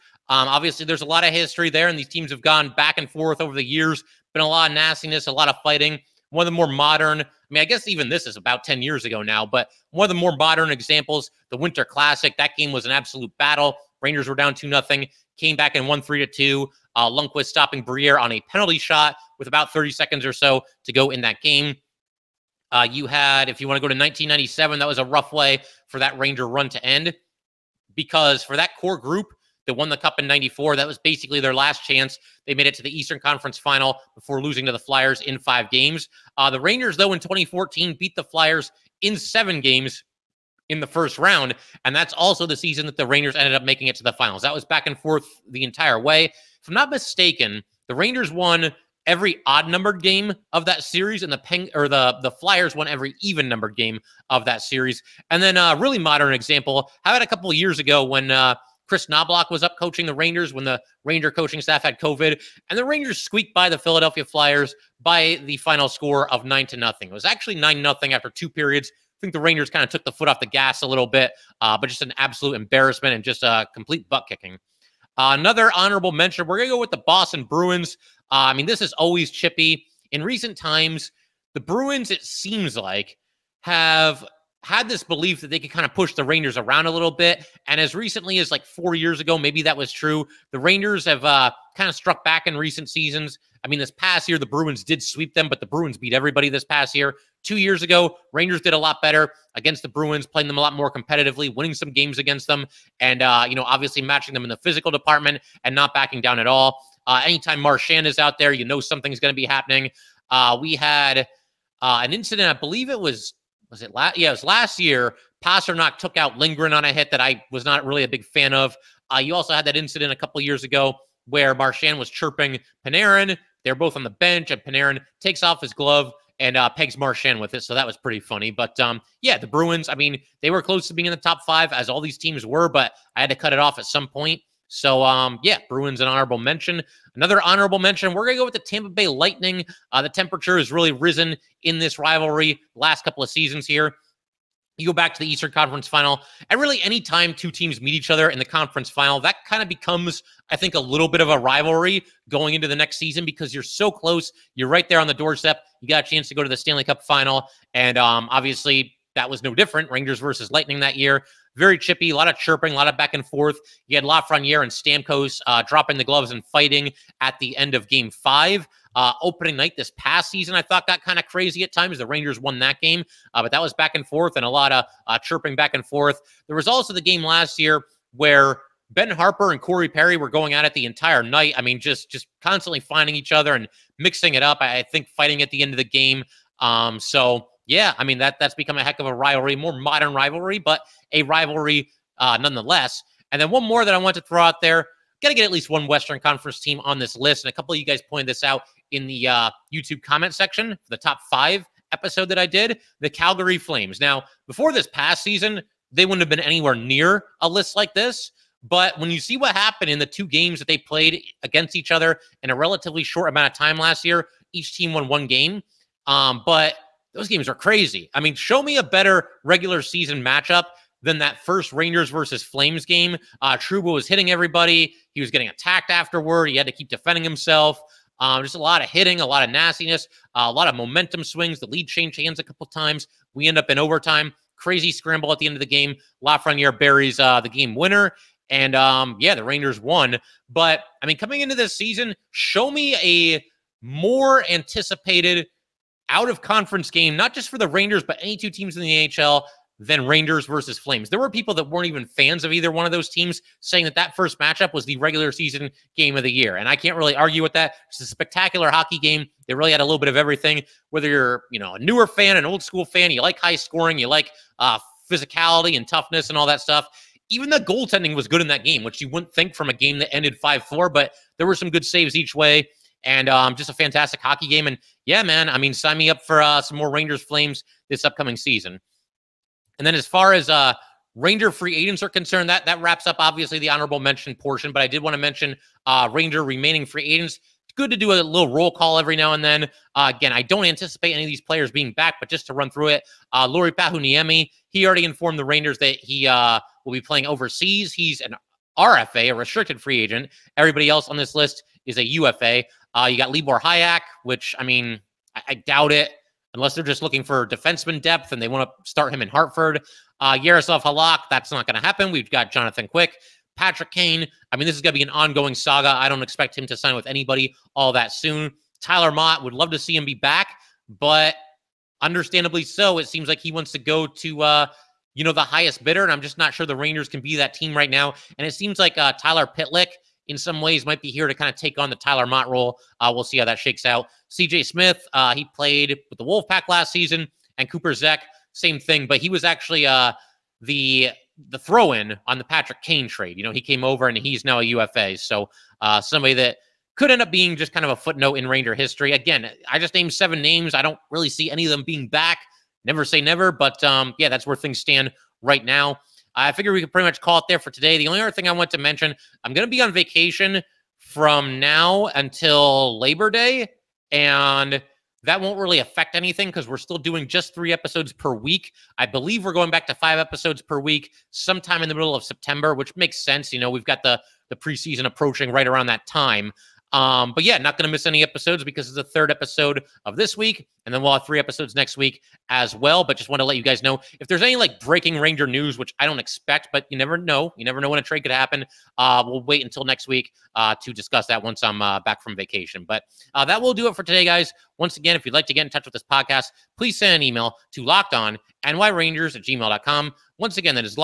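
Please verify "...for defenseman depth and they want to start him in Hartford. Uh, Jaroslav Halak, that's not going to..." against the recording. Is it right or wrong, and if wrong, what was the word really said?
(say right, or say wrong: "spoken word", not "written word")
right.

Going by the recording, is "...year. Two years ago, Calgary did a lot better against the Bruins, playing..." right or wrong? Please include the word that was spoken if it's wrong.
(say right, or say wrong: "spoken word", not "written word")
wrong: "Rangers", not "Calgary".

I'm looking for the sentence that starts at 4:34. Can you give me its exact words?
And yeah, man, I mean, sign me up for uh, some more Rangers Flames this upcoming season.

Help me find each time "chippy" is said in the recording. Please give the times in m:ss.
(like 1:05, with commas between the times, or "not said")
1:19, 2:41.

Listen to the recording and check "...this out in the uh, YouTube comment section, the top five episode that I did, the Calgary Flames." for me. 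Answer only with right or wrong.
right.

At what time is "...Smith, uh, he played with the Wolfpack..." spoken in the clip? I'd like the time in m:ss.
5:34.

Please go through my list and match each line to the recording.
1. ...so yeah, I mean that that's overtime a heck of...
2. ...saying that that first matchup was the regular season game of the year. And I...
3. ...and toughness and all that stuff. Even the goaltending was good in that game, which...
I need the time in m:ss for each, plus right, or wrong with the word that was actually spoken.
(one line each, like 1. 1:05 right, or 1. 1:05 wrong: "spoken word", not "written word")
1. 3:06 wrong: "become", not "overtime"
2. 4:13 right
3. 4:25 right.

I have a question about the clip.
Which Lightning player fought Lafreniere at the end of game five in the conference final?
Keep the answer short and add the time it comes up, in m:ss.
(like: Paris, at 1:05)
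Stamkos, at 2:45.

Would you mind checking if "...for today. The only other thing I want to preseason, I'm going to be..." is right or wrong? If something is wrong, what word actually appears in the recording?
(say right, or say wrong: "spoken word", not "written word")
wrong: "mention", not "preseason".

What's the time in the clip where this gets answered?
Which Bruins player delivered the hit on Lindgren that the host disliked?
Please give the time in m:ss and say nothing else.
1:55.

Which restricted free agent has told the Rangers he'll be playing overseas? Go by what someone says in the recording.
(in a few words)
Lauri Pajuniemi.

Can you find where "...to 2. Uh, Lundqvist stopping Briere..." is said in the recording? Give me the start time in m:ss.
0:16.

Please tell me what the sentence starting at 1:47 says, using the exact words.
Uh, anytime Marchand is out there, you know something's going to be happening.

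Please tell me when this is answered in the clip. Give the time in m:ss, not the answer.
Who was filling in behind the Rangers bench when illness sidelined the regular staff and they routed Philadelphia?
0:58.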